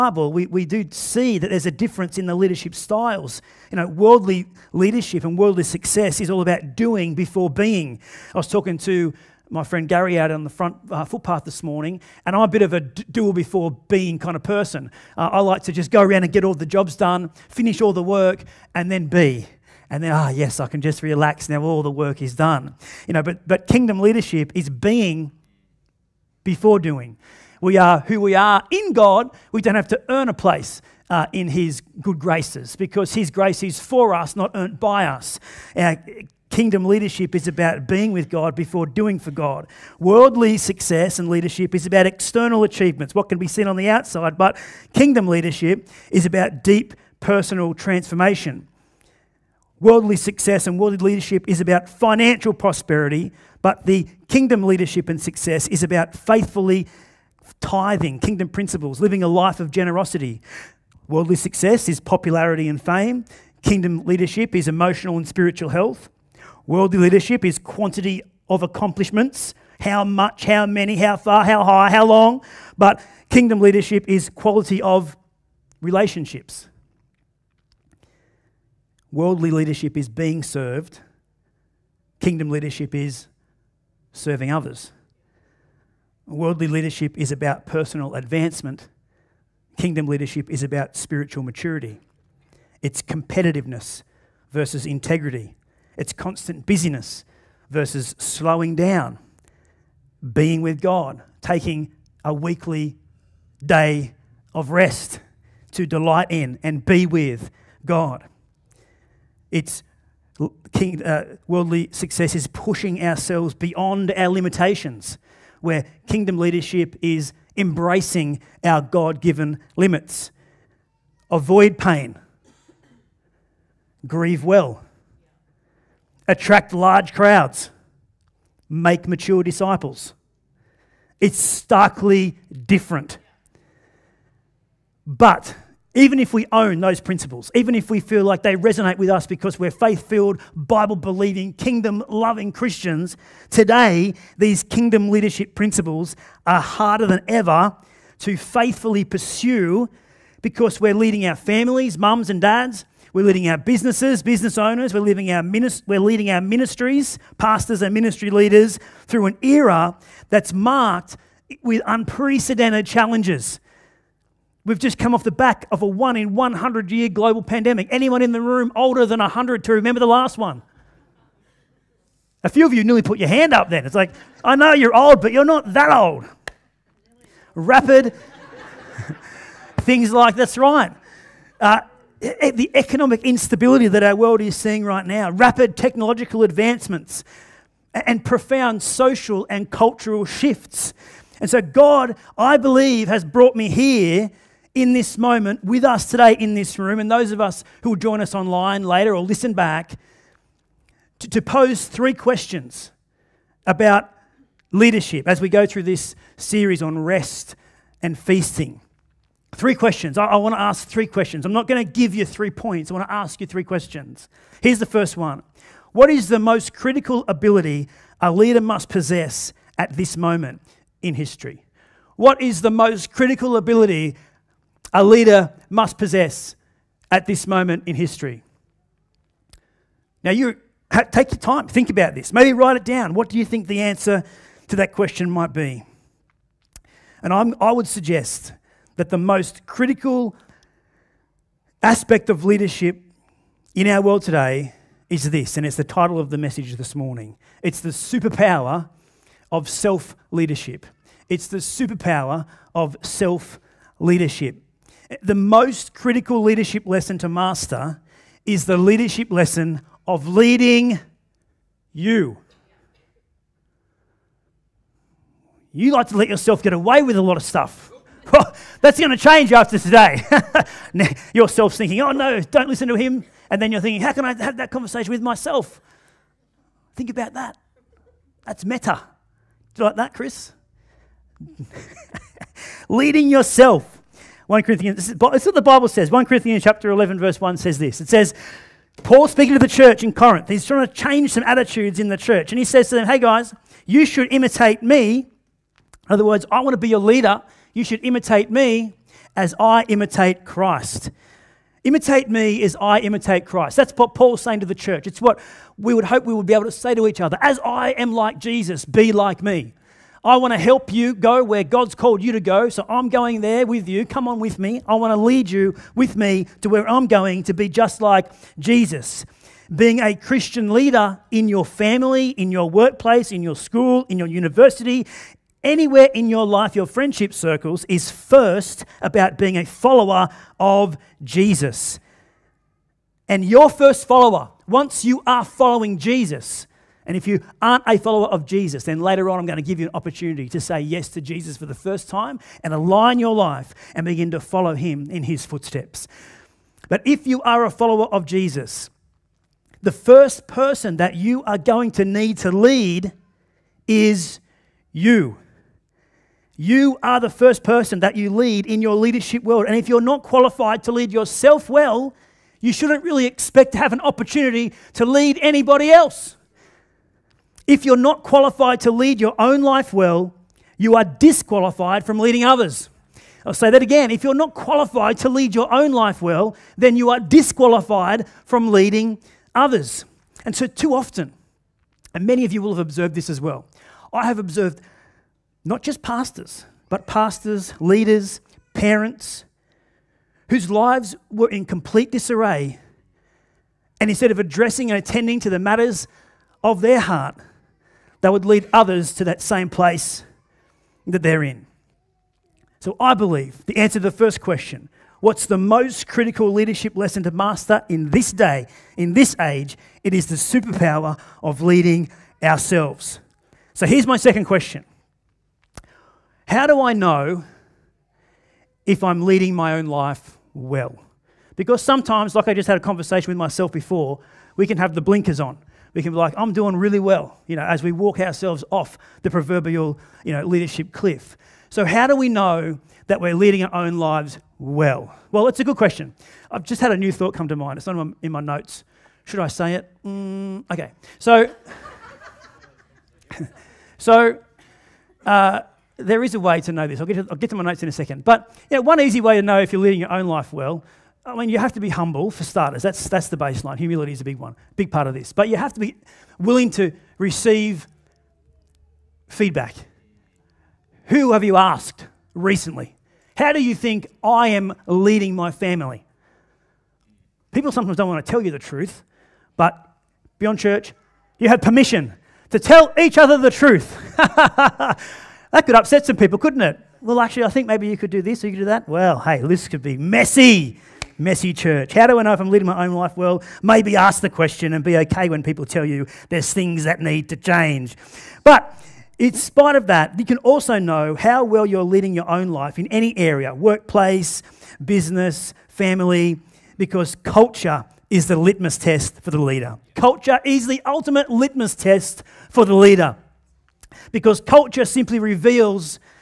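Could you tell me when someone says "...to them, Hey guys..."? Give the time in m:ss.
4:52.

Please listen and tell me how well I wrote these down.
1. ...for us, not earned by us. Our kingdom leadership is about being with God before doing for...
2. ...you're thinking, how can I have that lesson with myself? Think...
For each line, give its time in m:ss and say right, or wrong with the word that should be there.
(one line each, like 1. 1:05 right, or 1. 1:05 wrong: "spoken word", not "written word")
1. 0:33 right
2. 4:33 wrong: "conversation", not "lesson".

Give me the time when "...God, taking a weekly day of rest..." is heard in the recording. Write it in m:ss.
1:40.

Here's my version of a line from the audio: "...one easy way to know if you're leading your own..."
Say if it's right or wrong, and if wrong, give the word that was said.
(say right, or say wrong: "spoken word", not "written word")
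right.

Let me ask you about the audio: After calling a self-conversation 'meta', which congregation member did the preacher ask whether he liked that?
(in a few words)
Chris.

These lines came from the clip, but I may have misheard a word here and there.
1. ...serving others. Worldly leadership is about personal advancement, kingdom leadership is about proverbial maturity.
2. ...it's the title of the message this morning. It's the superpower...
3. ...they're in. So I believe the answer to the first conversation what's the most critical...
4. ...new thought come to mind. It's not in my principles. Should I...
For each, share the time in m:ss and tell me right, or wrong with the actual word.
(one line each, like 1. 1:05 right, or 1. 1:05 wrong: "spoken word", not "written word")
1. 1:24 wrong: "spiritual", not "proverbial"
2. 4:05 right
3. 6:41 wrong: "question", not "conversation"
4. 7:16 wrong: "notes", not "principles".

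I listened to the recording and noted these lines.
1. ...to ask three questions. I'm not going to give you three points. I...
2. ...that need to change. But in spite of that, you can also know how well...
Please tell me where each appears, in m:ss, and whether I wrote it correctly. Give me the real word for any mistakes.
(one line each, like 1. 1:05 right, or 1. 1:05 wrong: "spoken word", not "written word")
1. 3:30 right
2. 8:06 right.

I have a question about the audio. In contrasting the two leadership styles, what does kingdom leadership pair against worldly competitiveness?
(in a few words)
Integrity.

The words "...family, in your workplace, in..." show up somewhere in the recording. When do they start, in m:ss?
5:21.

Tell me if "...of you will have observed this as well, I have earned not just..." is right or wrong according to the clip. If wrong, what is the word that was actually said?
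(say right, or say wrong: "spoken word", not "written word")
wrong: "observed", not "earned".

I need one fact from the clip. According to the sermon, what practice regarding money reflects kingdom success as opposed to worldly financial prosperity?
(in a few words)
Faithfully tithing.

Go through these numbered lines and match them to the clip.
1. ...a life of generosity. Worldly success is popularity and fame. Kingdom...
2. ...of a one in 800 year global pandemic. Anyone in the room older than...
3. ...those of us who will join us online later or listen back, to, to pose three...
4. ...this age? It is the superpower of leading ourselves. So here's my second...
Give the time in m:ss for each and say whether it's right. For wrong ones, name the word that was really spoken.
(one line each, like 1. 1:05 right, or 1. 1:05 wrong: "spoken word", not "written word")
1. 0:59 right
2. 2:45 wrong: "100", not "800"
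3. 3:17 right
4. 6:49 right.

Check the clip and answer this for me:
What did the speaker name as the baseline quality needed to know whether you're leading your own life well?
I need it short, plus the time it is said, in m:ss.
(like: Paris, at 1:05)
Humility, at 7:33.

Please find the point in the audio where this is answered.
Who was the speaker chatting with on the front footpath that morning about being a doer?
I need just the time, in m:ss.
0:09.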